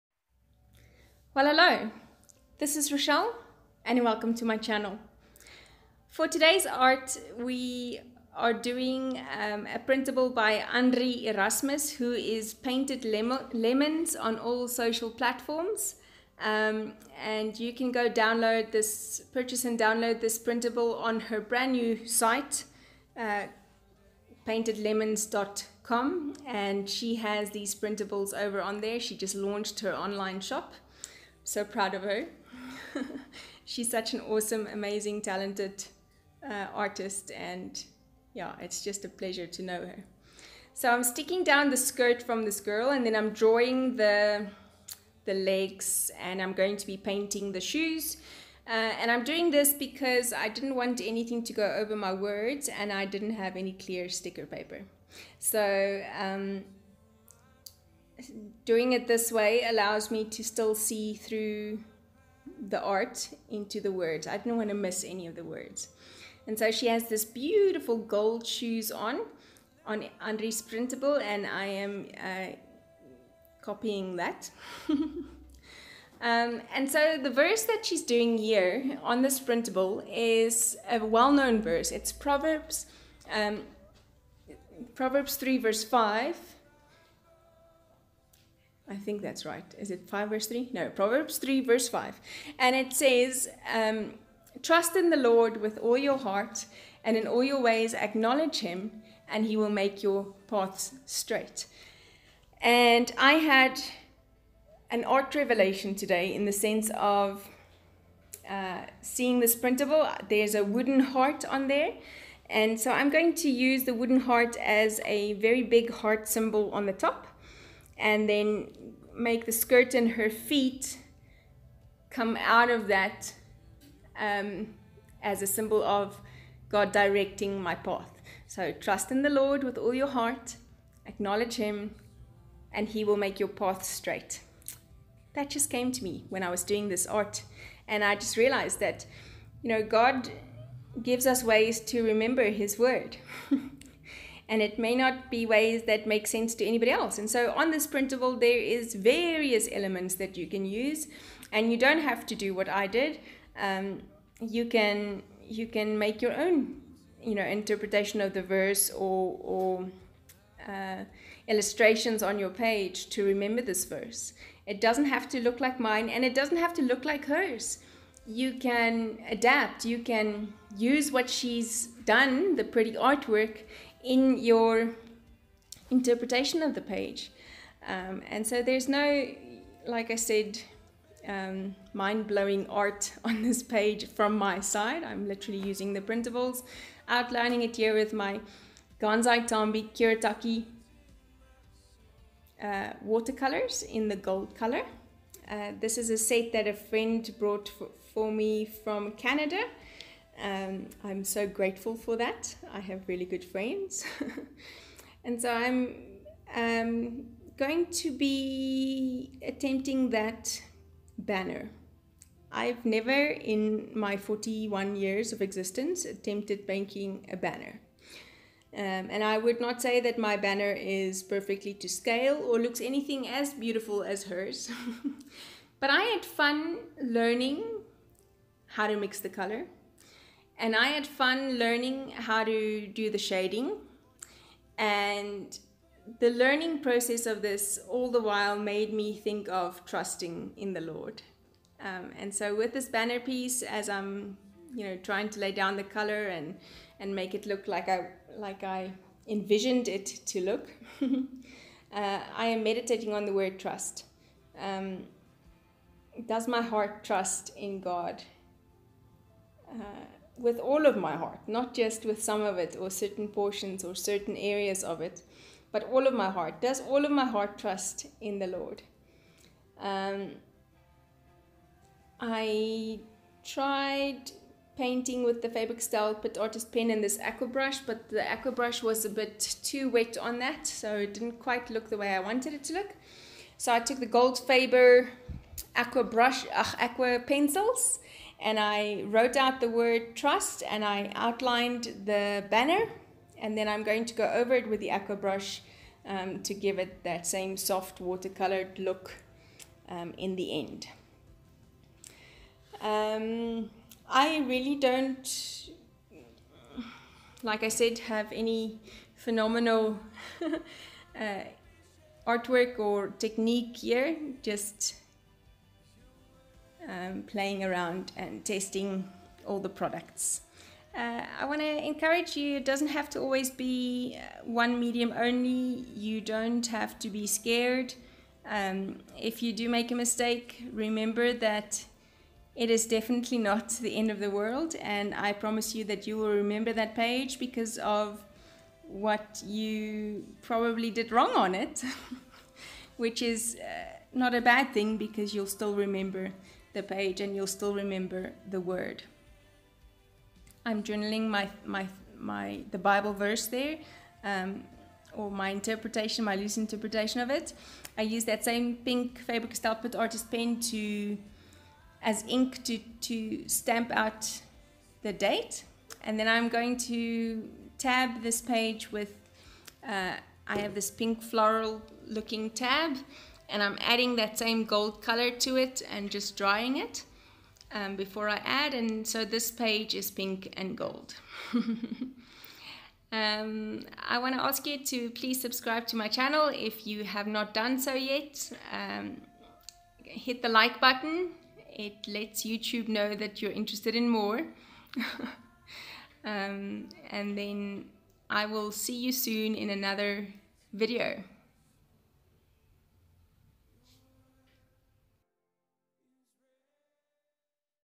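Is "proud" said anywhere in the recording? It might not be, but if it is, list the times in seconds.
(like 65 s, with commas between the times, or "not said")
31 s.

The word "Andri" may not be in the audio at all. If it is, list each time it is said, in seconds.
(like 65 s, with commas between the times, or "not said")
10 s, 70 s.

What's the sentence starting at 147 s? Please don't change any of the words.
And so on this printable, there is various elements that you can use, and you don't have to do what I did.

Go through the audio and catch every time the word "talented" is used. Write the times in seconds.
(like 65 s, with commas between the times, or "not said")
35 s.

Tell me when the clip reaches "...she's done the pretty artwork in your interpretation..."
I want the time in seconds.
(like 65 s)
171 s.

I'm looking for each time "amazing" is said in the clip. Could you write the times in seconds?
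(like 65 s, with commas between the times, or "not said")
34 s.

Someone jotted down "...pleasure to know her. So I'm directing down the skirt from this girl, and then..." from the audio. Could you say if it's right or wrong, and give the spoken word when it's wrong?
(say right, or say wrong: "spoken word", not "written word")
wrong: "sticking", not "directing".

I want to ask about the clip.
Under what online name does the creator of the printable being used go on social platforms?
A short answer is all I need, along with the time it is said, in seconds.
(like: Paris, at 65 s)
Painted Lemons, at 12 s.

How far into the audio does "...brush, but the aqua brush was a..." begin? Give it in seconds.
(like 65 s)
277 s.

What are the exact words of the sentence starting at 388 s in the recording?
Um, hit the like button, it lets YouTube know that you're interested in more.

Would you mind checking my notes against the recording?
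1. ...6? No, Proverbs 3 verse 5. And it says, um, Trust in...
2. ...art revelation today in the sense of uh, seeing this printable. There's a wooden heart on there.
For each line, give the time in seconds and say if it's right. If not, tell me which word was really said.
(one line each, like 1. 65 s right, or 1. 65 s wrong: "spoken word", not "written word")
1. 90 s wrong: "3", not "6"
2. 105 s right.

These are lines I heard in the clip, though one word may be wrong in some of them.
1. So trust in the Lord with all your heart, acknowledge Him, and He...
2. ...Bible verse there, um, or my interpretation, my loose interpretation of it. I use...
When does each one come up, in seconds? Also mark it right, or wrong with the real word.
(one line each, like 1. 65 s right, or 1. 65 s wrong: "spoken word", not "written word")
1. 128 s right
2. 352 s right.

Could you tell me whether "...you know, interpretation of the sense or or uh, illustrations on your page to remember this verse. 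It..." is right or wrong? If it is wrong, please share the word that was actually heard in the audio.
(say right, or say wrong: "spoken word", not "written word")
wrong: "verse", not "sense".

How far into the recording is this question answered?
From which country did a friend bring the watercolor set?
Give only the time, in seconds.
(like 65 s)
199 s.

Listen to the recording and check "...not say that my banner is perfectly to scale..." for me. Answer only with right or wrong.
right.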